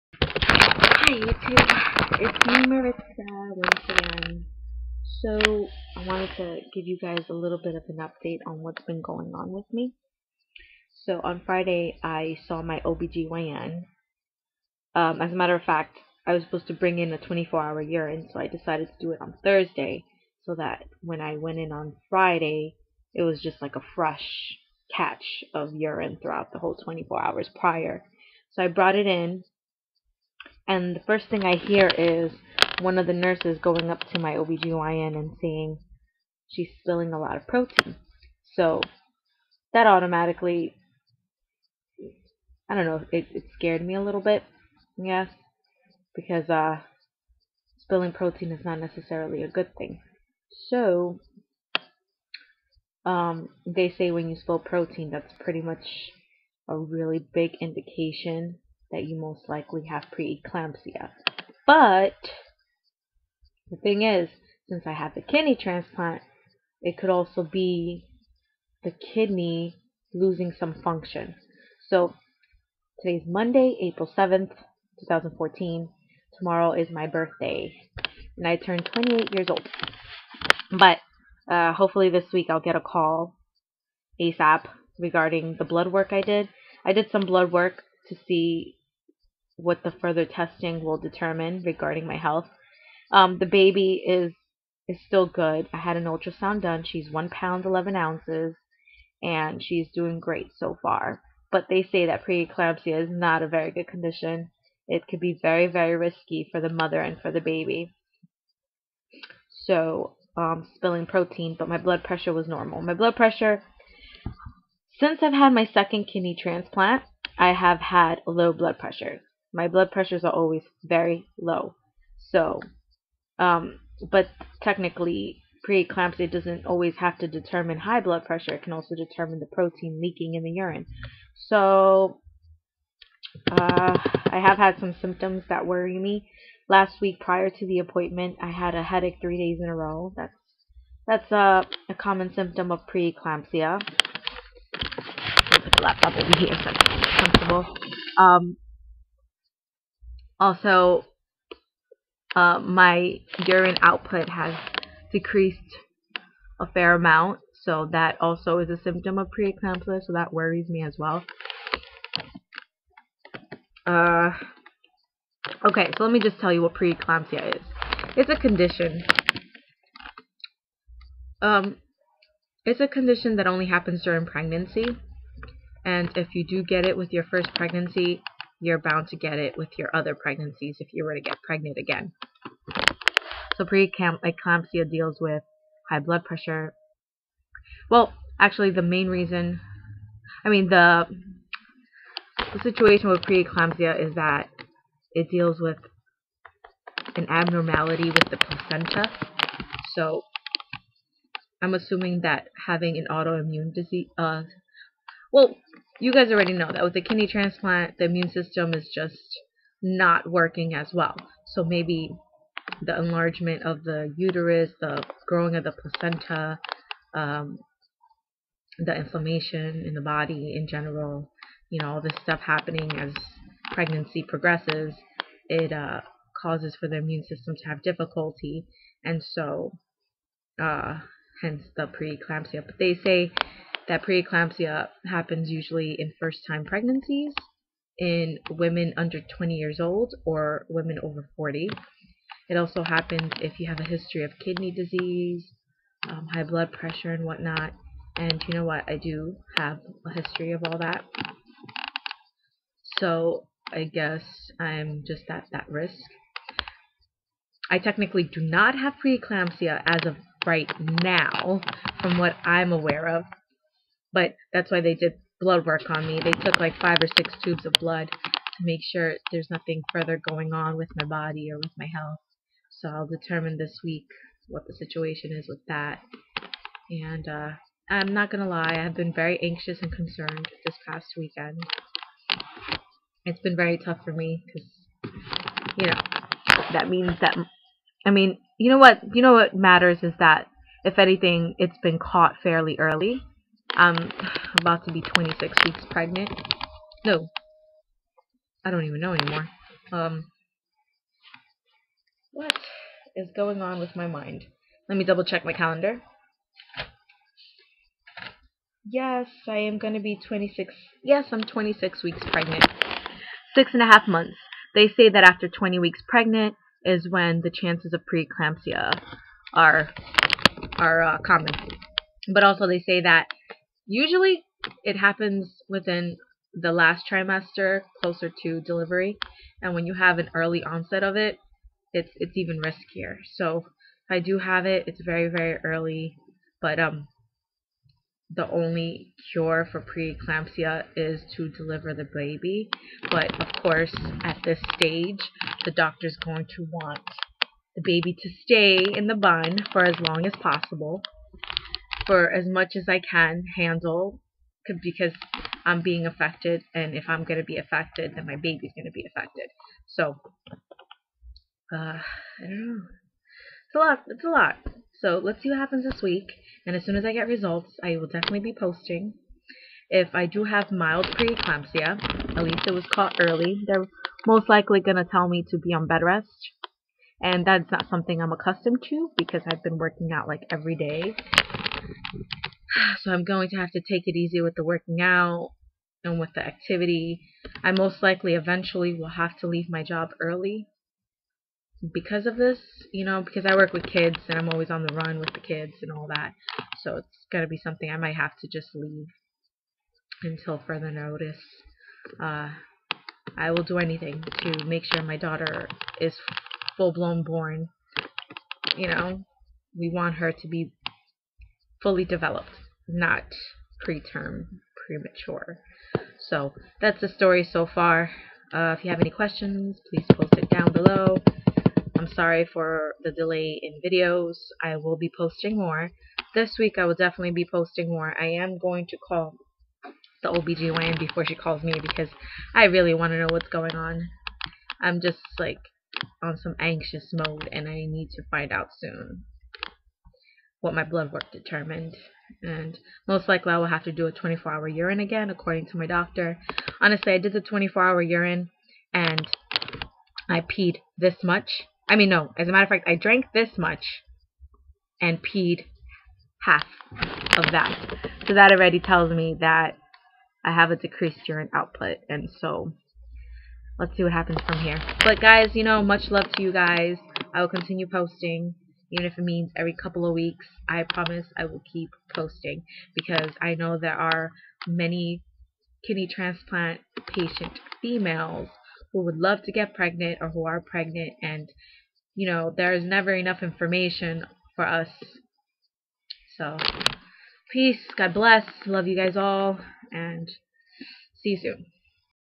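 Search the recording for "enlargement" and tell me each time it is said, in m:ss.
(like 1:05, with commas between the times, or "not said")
3:32.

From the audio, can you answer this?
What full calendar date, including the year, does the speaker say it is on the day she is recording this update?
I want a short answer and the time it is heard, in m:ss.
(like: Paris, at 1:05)
April 7, 2014, at 1:13.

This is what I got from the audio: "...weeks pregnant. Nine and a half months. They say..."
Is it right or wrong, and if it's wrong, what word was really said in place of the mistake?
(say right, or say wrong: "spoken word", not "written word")
wrong: "Six", not "Nine".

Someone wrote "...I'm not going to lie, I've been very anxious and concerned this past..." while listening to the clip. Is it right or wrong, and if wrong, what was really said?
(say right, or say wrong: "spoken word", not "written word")
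right.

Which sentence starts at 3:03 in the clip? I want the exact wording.
So preeclampsia deals with high blood pressure.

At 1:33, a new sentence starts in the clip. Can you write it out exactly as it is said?
Um, the baby is is still good.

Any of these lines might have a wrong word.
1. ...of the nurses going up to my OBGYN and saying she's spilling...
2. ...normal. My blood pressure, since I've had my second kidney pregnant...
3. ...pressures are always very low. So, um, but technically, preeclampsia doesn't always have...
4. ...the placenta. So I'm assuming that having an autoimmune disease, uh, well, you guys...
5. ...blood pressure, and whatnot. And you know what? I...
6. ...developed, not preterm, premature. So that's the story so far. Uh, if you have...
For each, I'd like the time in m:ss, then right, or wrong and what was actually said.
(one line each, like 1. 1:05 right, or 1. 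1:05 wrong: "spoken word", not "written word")
1. 0:32 right
2. 1:52 wrong: "transplant", not "pregnant"
3. 1:59 right
4. 3:18 right
5. 4:06 right
6. 6:52 right.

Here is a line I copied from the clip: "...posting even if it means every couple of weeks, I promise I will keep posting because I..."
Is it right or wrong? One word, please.
right.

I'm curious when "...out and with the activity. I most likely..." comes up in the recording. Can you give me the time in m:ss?
6:25.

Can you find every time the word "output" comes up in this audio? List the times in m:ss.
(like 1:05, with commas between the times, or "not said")
2:33, 7:41.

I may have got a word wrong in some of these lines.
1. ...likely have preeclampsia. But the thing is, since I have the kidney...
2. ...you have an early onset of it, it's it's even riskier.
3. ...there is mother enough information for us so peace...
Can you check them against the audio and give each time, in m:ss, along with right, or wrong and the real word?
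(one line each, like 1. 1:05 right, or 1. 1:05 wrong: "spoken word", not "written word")
1. 0:59 right
2. 5:29 right
3. 8:02 wrong: "never", not "mother".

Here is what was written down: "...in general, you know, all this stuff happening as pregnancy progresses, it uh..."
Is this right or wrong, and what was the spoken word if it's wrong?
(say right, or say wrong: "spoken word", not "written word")
right.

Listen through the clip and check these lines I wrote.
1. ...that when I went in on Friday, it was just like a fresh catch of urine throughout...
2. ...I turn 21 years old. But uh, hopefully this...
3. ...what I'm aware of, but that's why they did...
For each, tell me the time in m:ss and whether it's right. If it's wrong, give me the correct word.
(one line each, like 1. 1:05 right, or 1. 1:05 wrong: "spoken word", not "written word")
1. 0:20 right
2. 1:18 wrong: "28", not "21"
3. 4:22 right.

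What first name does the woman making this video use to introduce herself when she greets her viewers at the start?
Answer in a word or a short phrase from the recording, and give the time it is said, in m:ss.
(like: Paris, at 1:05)
Maritza, at 0:02.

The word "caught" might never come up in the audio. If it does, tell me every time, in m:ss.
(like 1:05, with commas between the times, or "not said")
4:51, 6:12.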